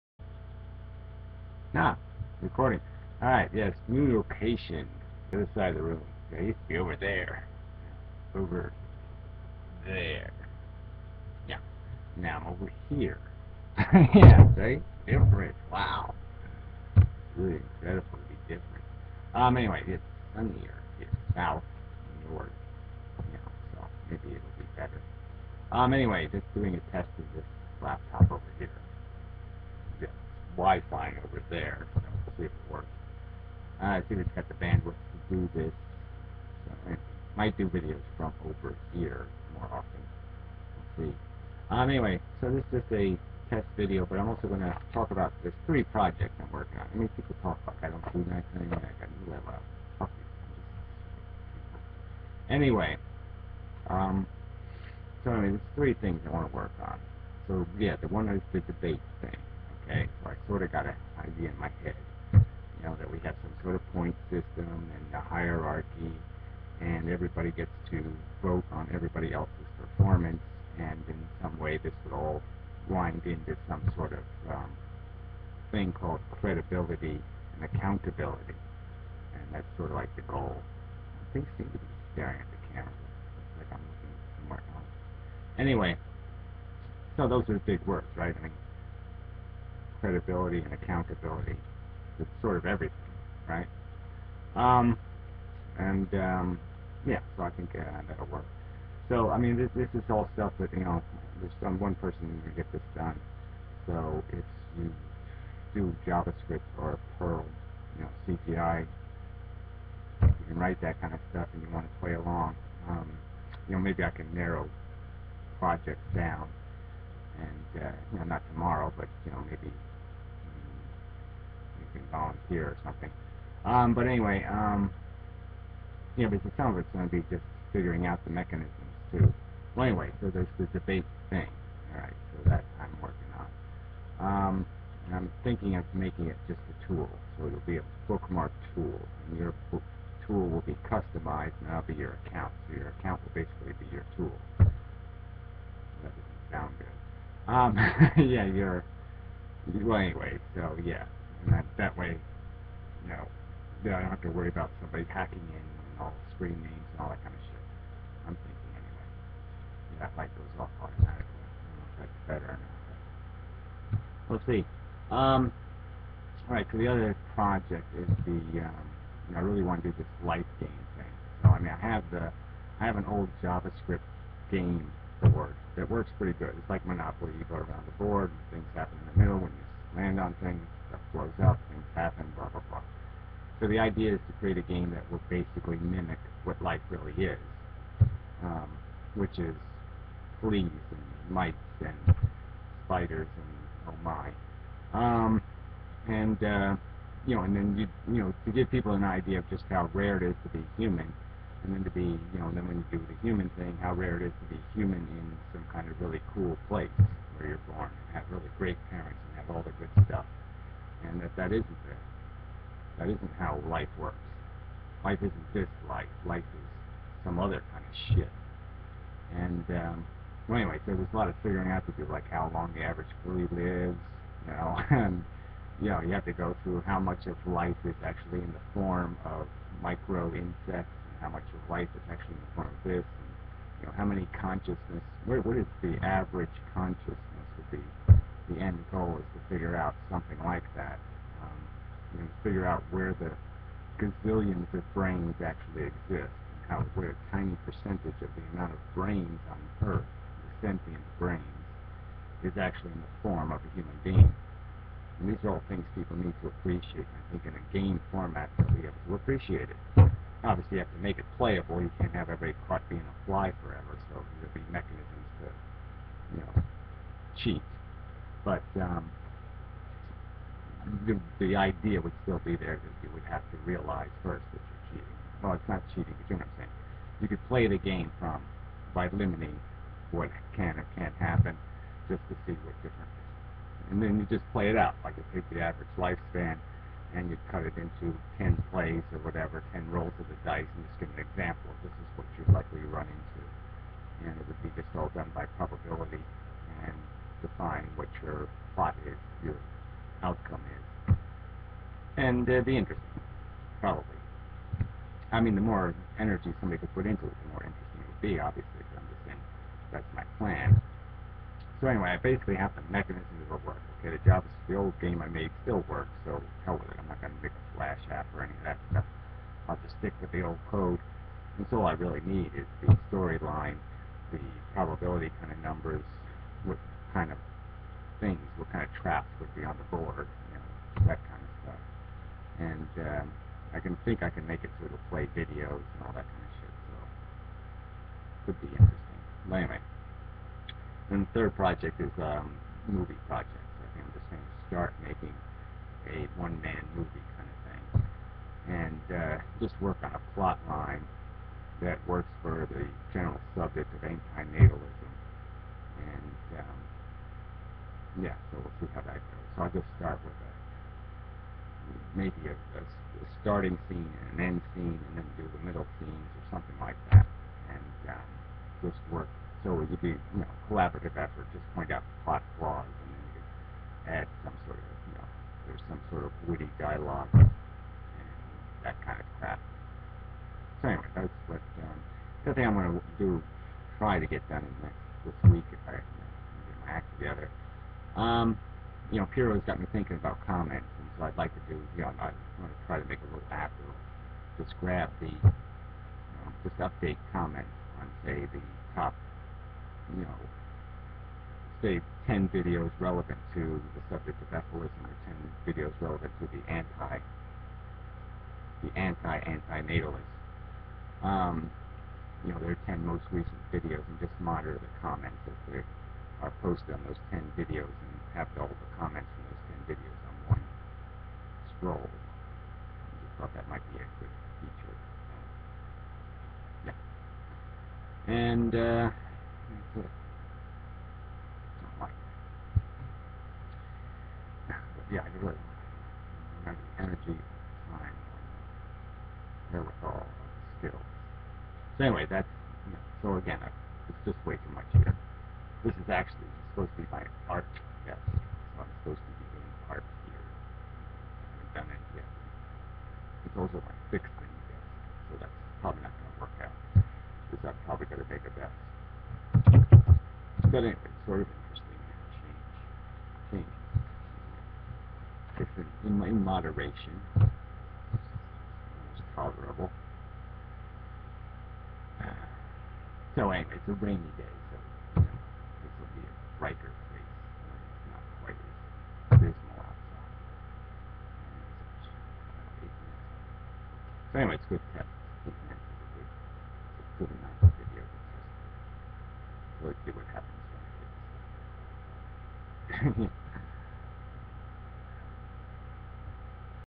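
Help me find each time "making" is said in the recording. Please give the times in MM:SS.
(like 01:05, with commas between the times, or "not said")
02:15, 05:45.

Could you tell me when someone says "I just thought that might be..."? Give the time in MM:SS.
07:02.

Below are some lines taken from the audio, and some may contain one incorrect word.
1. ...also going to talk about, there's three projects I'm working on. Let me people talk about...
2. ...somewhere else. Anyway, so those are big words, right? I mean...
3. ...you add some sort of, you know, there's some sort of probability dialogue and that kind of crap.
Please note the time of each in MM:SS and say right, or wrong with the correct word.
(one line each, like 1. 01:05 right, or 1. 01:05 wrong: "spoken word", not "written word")
1. 00:44 right
2. 01:24 right
3. 06:13 wrong: "witty", not "probability".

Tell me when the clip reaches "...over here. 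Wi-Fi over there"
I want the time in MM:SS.
00:28.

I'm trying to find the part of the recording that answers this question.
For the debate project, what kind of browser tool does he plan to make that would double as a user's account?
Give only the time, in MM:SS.
02:18.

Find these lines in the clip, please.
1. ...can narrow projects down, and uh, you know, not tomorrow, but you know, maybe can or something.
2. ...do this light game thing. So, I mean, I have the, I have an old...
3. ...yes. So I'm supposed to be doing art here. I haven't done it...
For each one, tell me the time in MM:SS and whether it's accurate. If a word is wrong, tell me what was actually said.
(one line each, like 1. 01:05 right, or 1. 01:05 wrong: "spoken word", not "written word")
1. 01:54 right
2. 02:49 right
3. 07:28 right.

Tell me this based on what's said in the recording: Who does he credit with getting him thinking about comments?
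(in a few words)
Piro.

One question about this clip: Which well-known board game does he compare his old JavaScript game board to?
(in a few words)
Monopoly.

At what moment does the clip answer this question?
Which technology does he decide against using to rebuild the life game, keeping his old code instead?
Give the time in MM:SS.
05:17.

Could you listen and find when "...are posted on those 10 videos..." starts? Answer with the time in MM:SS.
06:56.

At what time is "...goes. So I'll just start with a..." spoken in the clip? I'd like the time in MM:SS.
05:59.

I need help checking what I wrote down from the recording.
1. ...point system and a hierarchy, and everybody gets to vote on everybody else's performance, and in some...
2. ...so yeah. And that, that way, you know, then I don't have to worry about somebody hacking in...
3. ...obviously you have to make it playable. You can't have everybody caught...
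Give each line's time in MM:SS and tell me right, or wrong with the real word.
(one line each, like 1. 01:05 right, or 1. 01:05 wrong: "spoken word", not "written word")
1. 01:03 right
2. 02:30 right
3. 04:20 right.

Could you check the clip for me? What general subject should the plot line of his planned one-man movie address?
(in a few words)
anti-natalism.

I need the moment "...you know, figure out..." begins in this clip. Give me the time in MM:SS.
04:02.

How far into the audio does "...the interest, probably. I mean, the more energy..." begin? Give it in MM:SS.
05:02.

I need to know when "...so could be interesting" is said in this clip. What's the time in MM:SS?
05:36.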